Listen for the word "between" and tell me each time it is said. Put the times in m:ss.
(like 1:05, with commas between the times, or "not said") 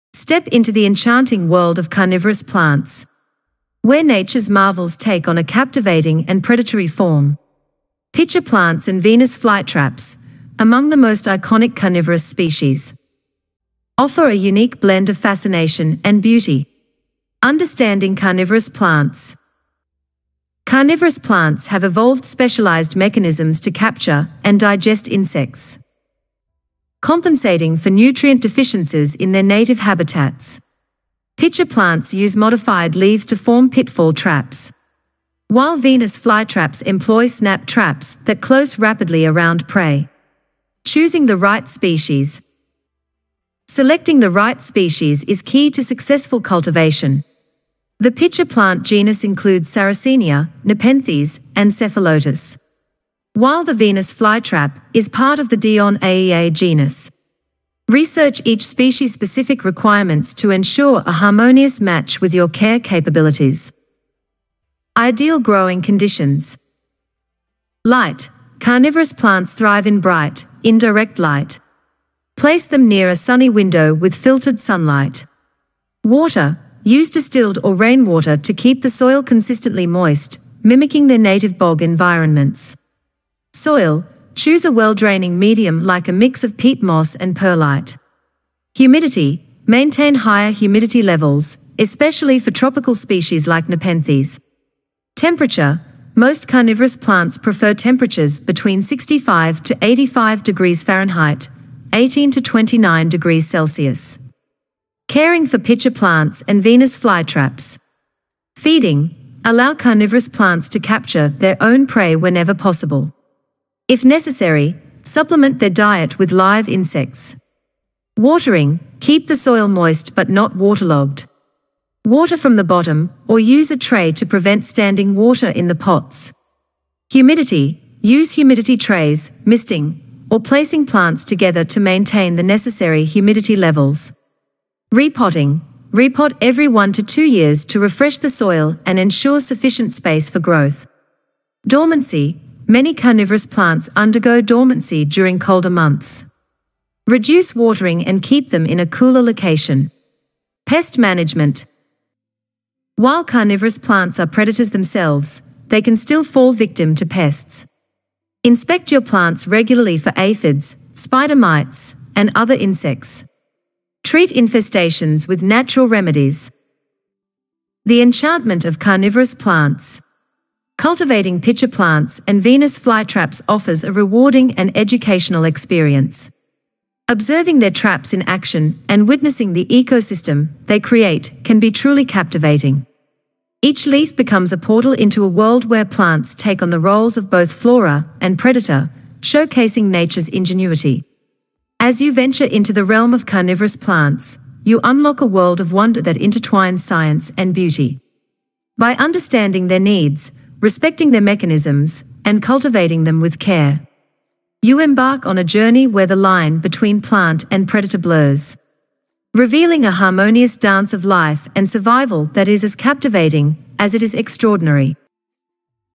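1:38, 3:26.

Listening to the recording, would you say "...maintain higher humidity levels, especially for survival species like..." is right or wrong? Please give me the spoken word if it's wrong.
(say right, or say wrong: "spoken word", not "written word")
wrong: "tropical", not "survival".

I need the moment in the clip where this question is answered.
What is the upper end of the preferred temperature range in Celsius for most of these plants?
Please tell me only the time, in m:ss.
1:42.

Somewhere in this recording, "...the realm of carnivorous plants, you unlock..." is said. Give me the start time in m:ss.
3:12.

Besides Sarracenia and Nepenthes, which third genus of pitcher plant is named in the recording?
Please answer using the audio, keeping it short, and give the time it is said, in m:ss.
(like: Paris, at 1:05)
Cephalotus, at 0:51.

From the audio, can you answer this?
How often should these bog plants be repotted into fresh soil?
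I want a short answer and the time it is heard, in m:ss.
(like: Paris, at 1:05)
Every 1 to 2 years, at 2:16.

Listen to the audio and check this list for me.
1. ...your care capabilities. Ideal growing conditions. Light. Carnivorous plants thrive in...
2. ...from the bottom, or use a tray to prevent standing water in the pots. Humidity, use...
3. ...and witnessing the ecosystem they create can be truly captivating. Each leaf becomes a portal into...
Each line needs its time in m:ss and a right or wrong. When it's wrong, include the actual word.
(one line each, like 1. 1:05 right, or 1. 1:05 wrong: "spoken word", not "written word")
1. 1:02 right
2. 2:02 right
3. 2:58 right.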